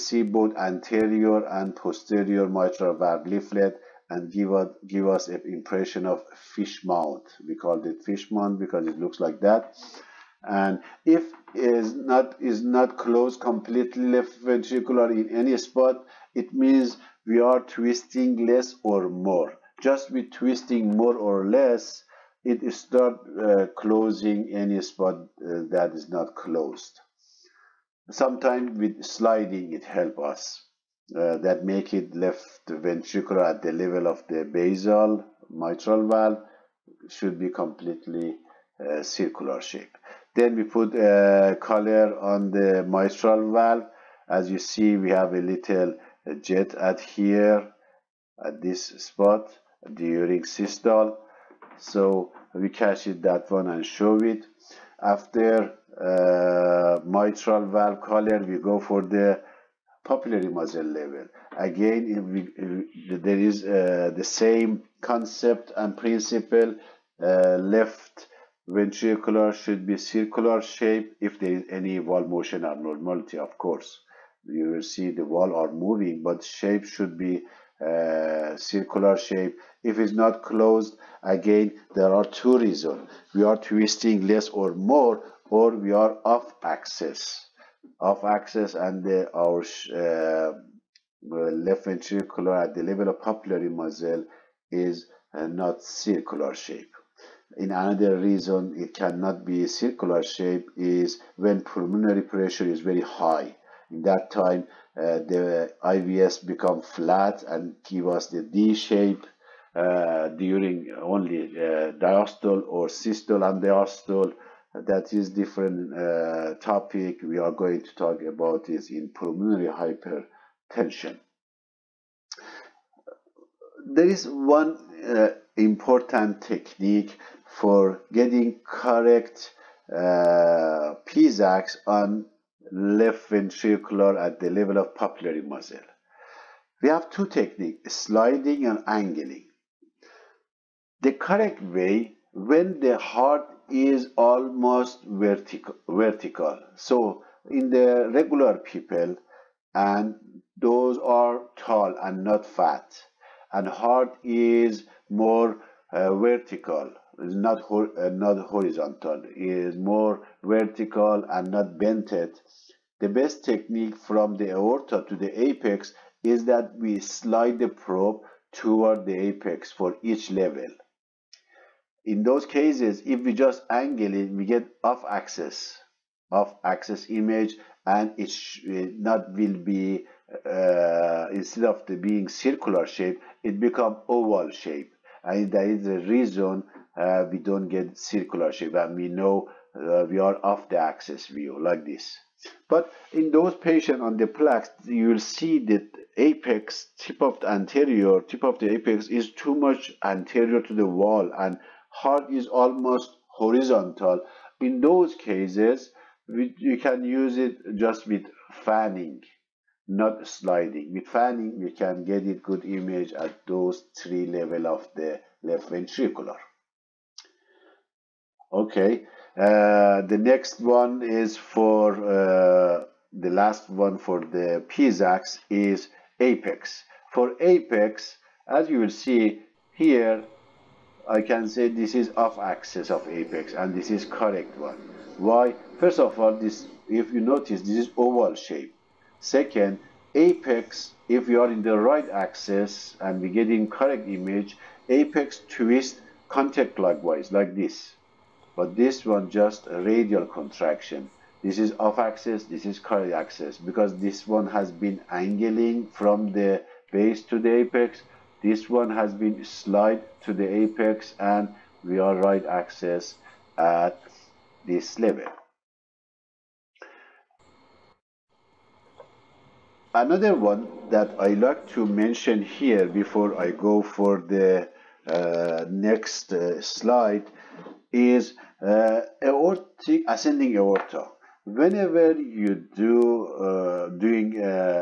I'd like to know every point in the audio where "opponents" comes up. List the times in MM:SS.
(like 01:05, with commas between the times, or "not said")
not said.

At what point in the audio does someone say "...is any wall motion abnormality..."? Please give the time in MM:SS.
01:11.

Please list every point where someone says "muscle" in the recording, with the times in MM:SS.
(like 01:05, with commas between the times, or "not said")
01:00, 01:33, 02:15.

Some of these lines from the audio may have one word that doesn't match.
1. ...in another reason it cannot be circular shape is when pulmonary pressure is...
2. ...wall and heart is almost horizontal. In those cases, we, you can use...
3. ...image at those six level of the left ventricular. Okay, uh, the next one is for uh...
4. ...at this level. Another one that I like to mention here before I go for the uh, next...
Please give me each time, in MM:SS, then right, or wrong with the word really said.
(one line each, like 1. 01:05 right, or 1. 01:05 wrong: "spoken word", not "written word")
1. 01:37 right
2. 03:20 right
3. 03:32 wrong: "three", not "six"
4. 04:23 right.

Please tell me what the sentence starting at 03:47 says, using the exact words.
For apex, as you will see here, I can say this is off axis of apex and this is correct one.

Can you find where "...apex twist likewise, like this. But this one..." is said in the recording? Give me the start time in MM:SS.
04:04.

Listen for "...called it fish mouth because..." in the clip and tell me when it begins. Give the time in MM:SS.
00:07.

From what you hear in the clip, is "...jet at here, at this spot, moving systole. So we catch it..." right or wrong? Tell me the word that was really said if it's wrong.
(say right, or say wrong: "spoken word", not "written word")
wrong: "during", not "moving".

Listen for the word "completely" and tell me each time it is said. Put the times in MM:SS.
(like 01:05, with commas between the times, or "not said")
00:13, 00:37.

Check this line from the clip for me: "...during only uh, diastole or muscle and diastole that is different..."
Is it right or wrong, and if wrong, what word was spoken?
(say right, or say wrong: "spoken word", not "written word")
wrong: "systole", not "muscle".